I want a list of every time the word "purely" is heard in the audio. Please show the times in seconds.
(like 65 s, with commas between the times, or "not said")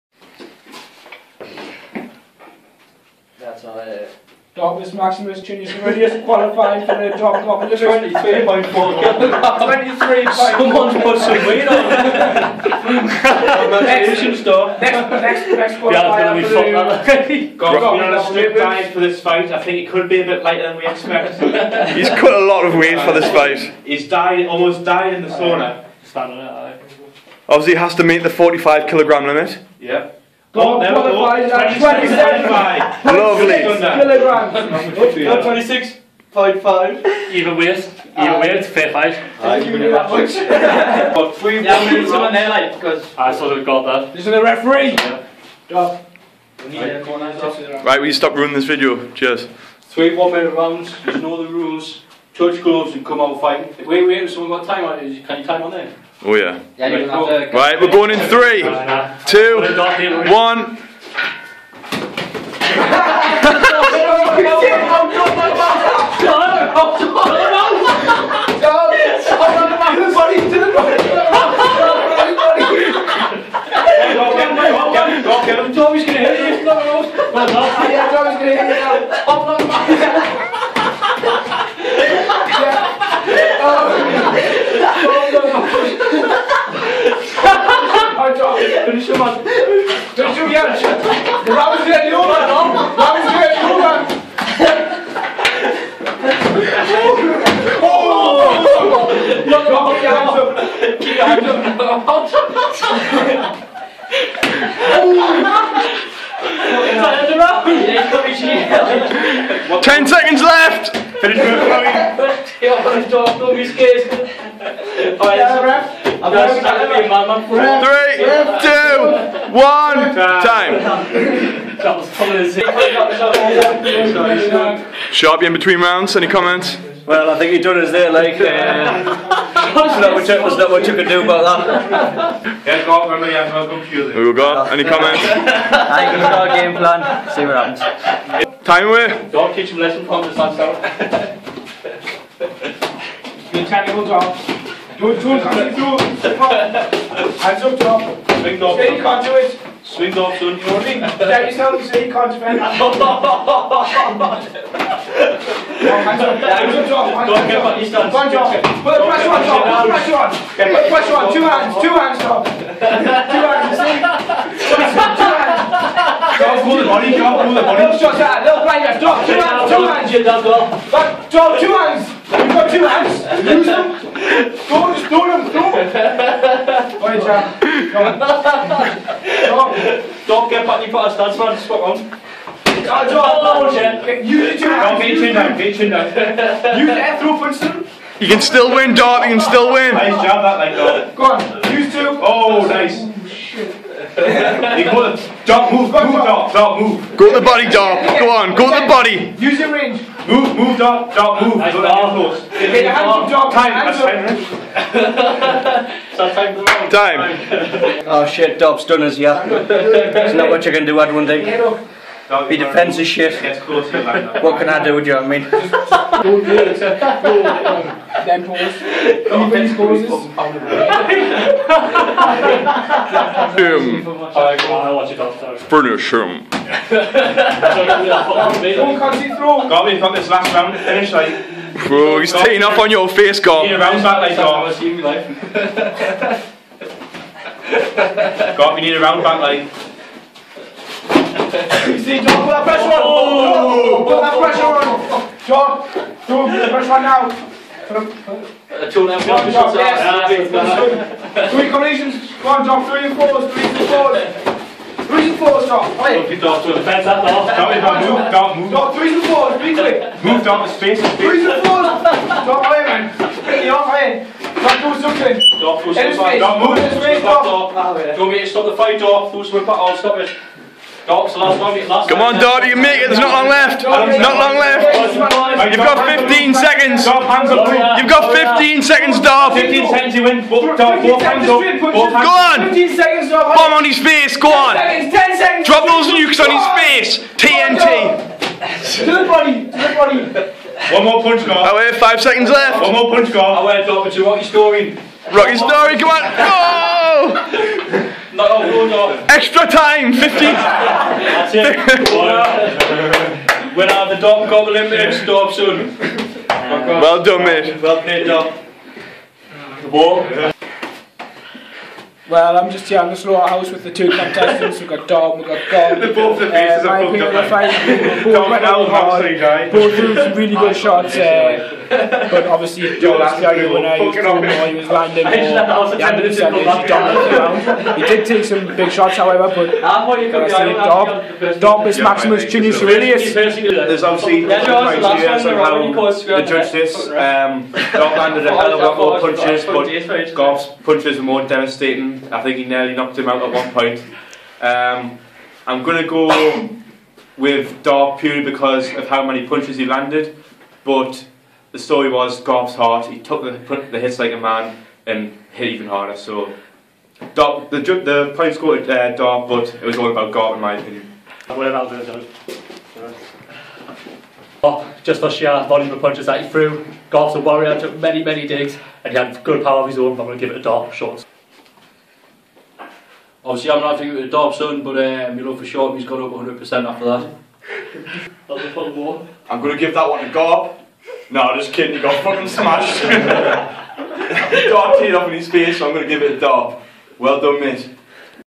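348 s.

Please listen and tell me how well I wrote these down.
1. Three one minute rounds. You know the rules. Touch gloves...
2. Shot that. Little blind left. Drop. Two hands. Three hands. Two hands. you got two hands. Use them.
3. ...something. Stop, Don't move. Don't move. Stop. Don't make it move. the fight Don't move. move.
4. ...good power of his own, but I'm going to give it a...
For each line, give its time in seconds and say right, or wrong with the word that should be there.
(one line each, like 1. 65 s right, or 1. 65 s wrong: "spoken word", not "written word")
1. 49 s right
2. 168 s wrong: "Two", not "Three"
3. 265 s right
4. 369 s right.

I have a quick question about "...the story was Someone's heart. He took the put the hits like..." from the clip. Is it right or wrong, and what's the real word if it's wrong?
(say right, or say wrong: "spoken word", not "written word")
wrong: "Garp", not "Someone".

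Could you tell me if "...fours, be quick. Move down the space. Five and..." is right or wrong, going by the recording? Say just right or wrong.
wrong.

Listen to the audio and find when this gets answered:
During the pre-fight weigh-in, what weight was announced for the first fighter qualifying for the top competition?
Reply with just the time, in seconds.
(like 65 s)
8 s.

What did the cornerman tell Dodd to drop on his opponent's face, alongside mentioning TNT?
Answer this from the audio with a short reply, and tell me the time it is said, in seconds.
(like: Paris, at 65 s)
Nukes, at 286 s.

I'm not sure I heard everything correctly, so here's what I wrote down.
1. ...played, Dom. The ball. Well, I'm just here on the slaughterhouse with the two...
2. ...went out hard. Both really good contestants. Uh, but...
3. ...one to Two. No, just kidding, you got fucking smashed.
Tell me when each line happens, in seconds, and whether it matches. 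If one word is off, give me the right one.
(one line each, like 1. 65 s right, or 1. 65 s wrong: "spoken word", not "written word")
1. 308 s right
2. 318 s wrong: "shots", not "contestants"
3. 380 s wrong: "Gob", not "Two".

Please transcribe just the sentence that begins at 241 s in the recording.
you see, John, put that pressure on!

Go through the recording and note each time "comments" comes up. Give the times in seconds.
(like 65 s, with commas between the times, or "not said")
126 s, 134 s.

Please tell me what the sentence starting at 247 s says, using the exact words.
two eh, Three collisions, one drop, three and fours, three and fours.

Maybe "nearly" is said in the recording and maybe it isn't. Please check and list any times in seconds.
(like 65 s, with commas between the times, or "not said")
342 s.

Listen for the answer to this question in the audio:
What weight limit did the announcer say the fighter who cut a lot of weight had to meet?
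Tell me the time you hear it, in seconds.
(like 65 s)
28 s.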